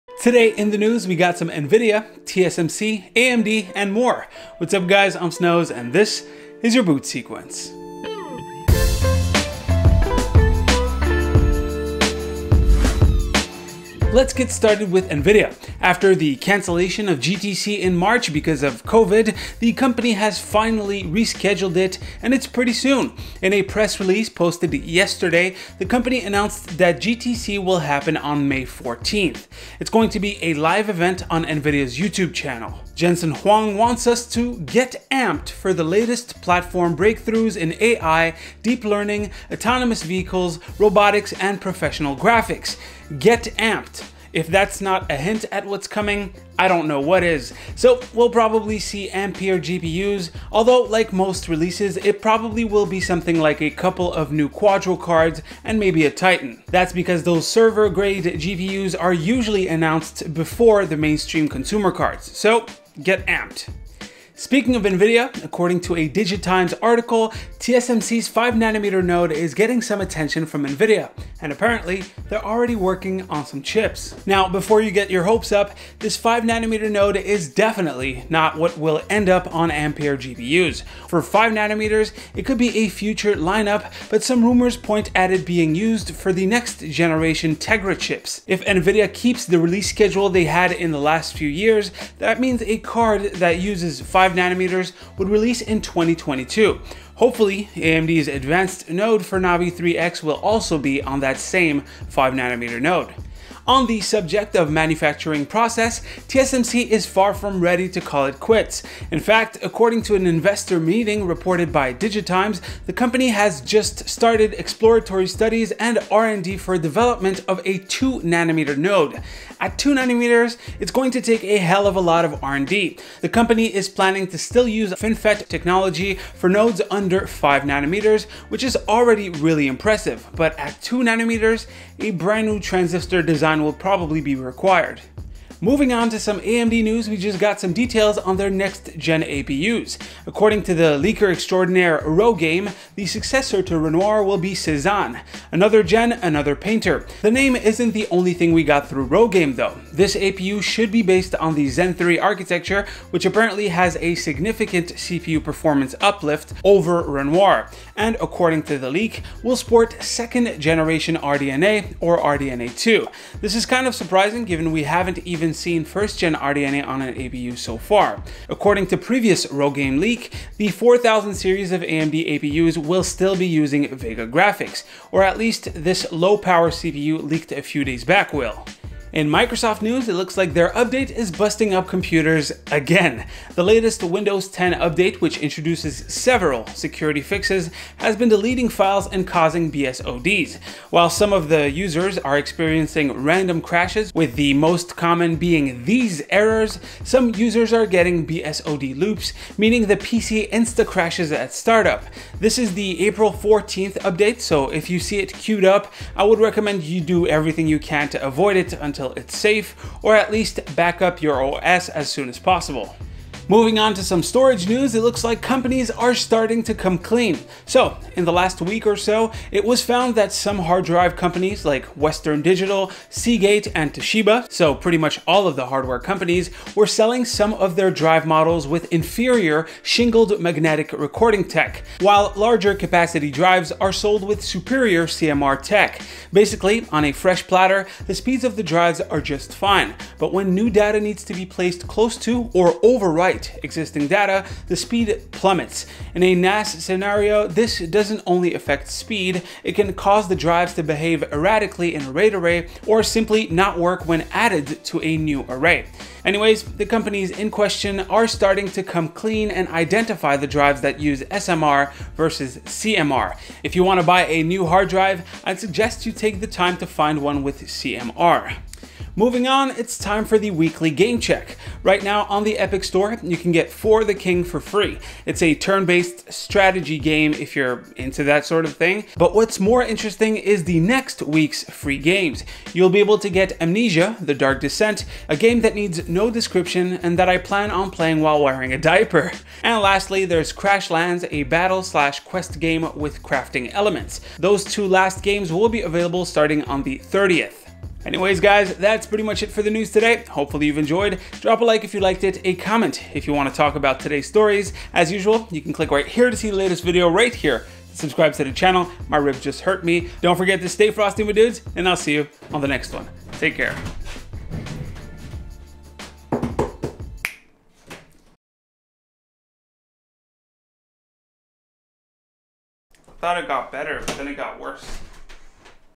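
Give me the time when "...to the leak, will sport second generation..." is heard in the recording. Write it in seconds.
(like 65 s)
158 s.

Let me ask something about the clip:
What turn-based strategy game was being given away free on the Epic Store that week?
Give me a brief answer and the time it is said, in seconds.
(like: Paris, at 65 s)
For the King, at 273 s.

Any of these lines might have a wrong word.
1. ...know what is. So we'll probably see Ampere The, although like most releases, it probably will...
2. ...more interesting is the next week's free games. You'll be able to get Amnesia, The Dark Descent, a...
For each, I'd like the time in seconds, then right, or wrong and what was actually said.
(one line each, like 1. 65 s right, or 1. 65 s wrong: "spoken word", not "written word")
1. 46 s wrong: "GPUs", not "The"
2. 279 s right.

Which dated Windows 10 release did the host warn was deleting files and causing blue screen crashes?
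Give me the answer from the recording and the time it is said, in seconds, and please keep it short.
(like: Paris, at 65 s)
April 14th update, at 203 s.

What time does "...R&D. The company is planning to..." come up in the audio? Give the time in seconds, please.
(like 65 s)
122 s.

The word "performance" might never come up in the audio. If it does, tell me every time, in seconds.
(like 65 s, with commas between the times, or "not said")
155 s.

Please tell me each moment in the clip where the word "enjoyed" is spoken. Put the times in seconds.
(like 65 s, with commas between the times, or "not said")
300 s.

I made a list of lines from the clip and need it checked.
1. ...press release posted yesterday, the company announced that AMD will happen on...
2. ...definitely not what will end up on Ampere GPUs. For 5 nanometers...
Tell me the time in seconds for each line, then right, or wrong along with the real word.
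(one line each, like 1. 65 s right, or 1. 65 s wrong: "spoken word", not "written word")
1. 23 s wrong: "GTC", not "AMD"
2. 77 s right.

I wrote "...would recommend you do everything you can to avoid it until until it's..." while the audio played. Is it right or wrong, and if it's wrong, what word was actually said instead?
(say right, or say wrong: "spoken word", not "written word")
right.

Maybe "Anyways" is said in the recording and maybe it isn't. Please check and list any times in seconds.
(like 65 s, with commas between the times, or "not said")
256 s, 298 s.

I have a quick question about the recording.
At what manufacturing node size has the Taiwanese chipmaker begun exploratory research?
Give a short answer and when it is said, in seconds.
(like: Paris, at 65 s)
2 nanometers, at 117 s.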